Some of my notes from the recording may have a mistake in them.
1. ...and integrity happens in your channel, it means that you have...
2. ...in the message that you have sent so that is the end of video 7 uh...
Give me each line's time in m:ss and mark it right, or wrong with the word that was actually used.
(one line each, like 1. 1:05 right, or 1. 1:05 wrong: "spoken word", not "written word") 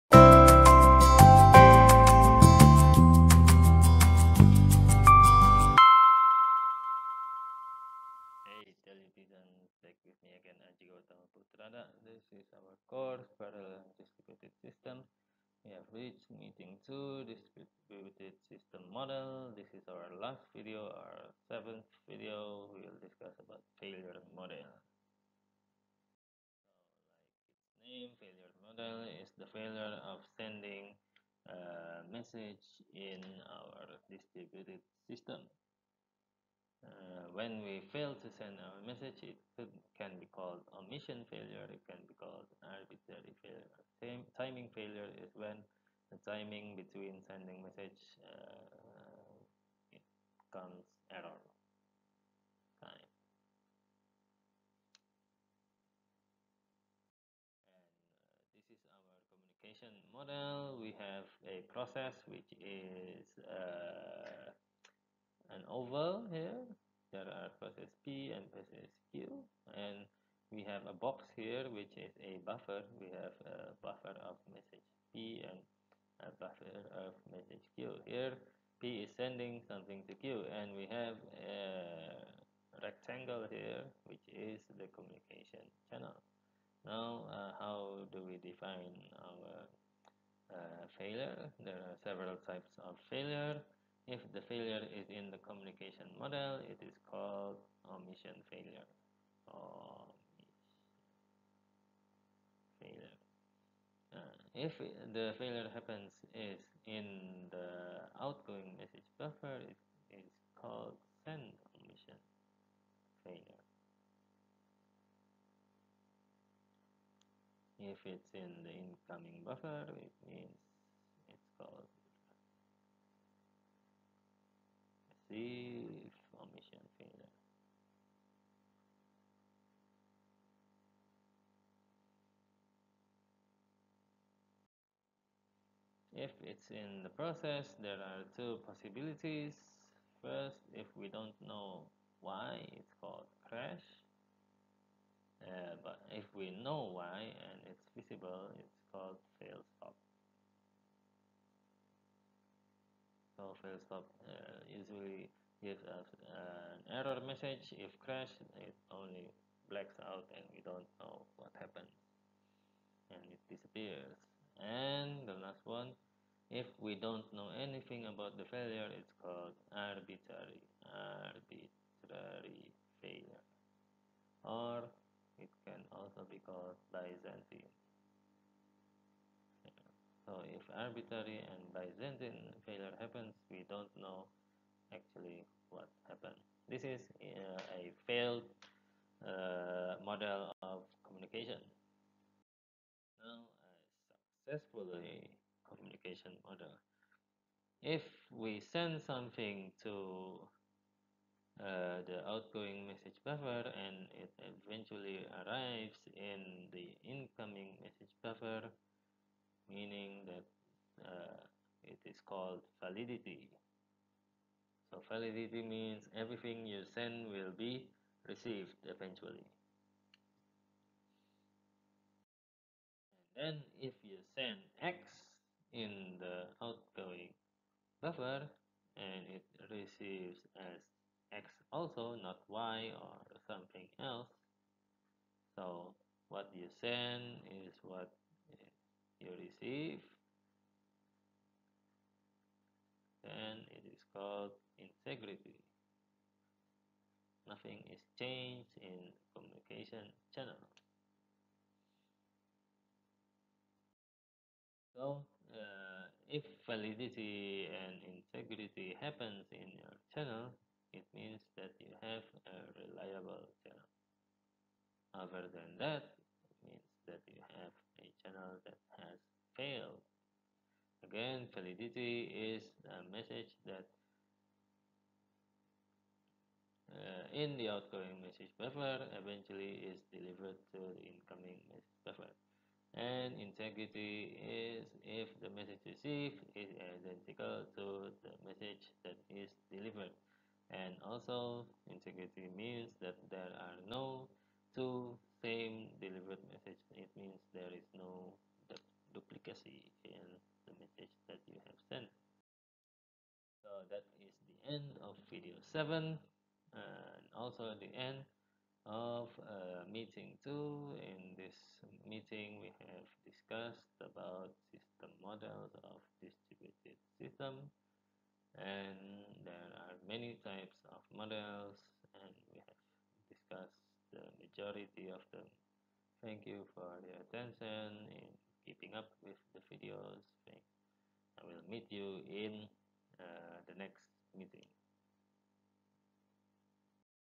1. 4:17 right
2. 5:00 right.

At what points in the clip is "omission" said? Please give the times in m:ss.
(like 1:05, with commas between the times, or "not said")
0:40, 1:37, 1:51.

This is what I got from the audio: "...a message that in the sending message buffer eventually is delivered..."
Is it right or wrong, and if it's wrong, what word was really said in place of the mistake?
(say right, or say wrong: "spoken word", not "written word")
wrong: "outgoing", not "sending".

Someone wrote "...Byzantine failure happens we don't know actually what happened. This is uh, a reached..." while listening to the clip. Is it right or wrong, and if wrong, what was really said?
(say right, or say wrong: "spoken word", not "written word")
wrong: "failed", not "reached".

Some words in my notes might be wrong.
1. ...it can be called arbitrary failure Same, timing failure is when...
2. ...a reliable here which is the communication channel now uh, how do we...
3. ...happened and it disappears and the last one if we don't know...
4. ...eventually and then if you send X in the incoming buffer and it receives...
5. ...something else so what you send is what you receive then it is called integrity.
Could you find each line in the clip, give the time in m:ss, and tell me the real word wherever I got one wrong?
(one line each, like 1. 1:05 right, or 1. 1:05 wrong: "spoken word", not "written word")
1. 0:41 right
2. 1:21 wrong: "rectangle", not "reliable"
3. 2:41 right
4. 3:38 wrong: "outgoing", not "incoming"
5. 3:53 right.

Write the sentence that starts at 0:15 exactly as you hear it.
We have reached meeting 2, Distributed System Model.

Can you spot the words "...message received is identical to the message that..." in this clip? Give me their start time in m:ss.
4:45.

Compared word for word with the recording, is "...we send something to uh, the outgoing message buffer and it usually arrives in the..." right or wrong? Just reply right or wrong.
wrong.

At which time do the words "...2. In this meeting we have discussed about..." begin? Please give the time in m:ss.
5:10.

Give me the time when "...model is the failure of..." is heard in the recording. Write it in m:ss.
0:28.